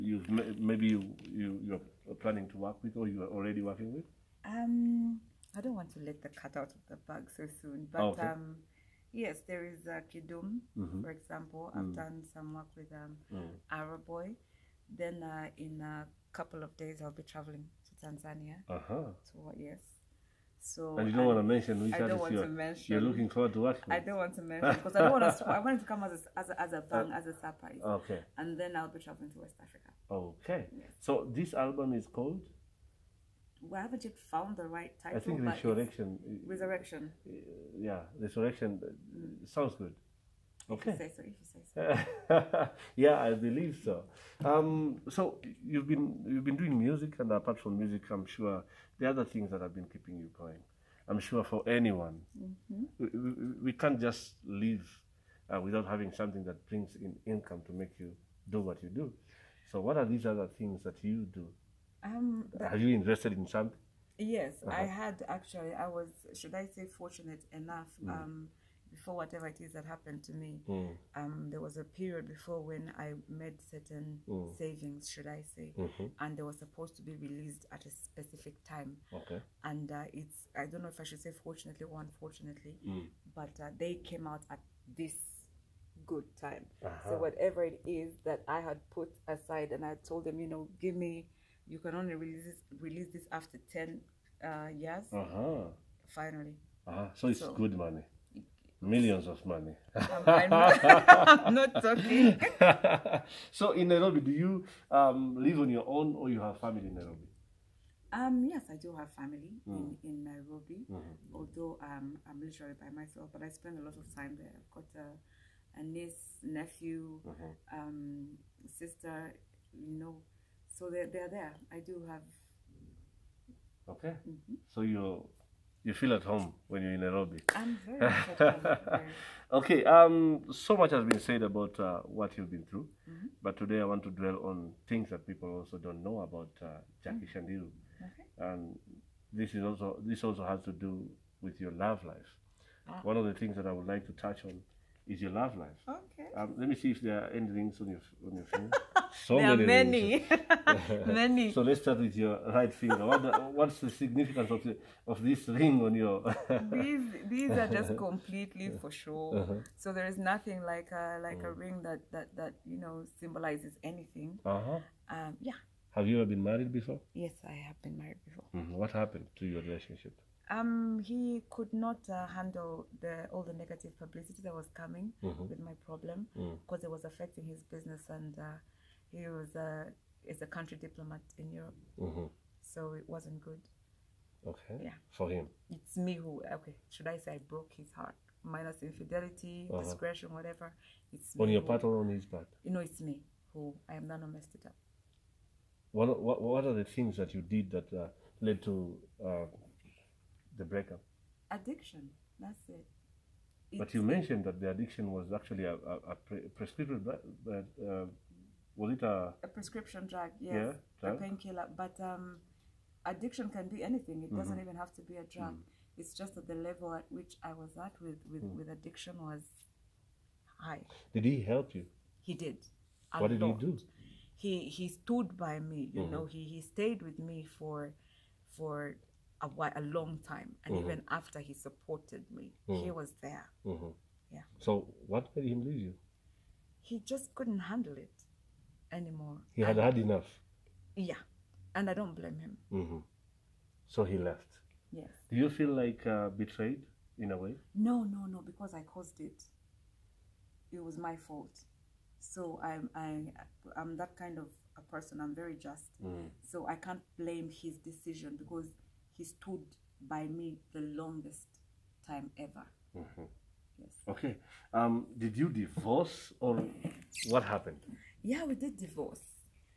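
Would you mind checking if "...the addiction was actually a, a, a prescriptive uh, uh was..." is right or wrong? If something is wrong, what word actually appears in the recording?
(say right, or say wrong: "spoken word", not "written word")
right.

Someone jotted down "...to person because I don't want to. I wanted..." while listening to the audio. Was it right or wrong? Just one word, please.
wrong.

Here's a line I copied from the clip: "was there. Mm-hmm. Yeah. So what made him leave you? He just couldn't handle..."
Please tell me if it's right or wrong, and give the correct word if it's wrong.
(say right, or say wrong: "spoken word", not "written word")
right.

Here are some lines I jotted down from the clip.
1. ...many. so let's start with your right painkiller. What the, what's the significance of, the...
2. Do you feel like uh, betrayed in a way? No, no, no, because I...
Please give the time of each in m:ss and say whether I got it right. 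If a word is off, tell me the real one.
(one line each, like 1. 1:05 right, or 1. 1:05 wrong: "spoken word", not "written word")
1. 2:31 wrong: "finger", not "painkiller"
2. 4:05 right.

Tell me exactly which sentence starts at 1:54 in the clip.
I've got a, a niece, nephew, mm-hmm.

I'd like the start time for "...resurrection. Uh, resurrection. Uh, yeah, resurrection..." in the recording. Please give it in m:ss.
0:35.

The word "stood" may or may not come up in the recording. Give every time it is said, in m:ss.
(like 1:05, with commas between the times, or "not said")
3:44, 4:19.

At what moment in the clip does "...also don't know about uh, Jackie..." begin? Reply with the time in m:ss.
2:15.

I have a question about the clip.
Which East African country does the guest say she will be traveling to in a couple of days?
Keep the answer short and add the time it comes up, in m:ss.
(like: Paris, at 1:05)
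Tanzania, at 0:18.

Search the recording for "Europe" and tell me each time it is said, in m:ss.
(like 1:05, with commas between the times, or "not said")
3:01.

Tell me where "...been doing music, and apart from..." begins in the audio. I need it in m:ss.
0:46.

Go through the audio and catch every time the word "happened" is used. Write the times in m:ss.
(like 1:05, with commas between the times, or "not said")
1:09, 2:48, 4:27.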